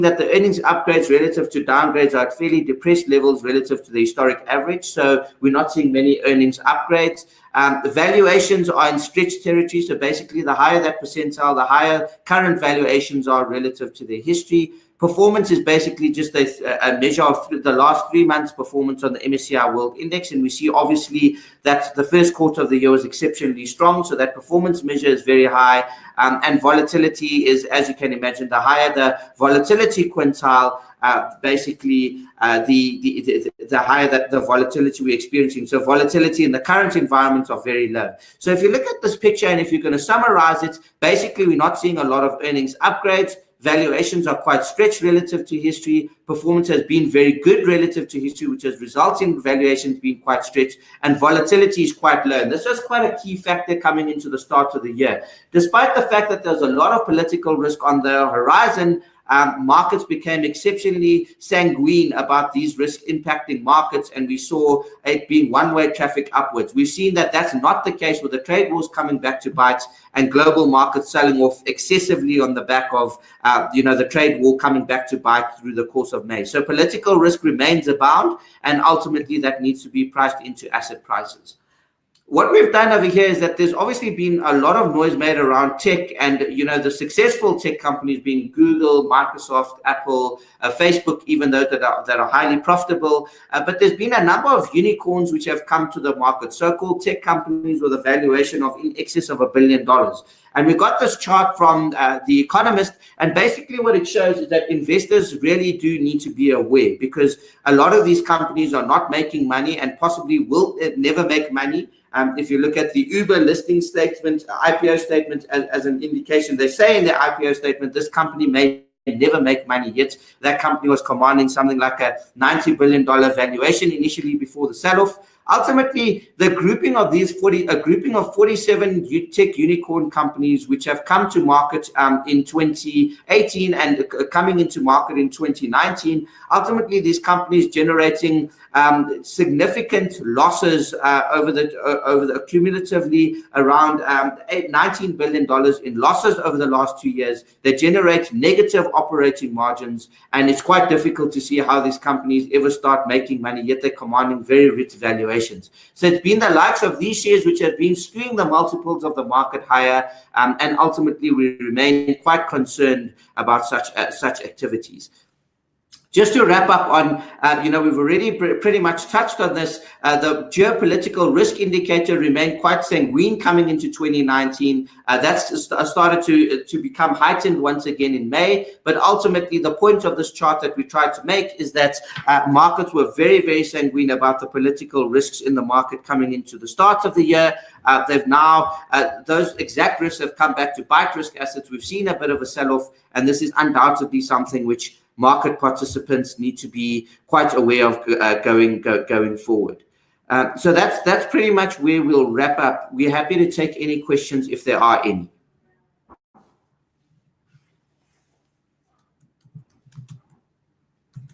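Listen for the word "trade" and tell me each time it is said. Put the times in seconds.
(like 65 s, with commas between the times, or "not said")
68 s, 74 s.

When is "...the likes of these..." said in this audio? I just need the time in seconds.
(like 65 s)
156 s.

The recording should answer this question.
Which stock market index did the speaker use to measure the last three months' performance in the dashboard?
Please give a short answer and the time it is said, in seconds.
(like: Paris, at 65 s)
MSCI World Index, at 19 s.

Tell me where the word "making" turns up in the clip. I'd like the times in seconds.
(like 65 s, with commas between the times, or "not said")
109 s, 153 s.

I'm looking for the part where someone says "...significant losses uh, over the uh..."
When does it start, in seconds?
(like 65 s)
139 s.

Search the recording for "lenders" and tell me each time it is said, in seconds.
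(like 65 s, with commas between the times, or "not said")
not said.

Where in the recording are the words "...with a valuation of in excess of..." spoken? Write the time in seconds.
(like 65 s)
97 s.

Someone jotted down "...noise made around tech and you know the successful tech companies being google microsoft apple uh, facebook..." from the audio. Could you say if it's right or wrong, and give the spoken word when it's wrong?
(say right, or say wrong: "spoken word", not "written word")
right.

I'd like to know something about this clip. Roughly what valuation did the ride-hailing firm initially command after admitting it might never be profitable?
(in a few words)
$90 billion.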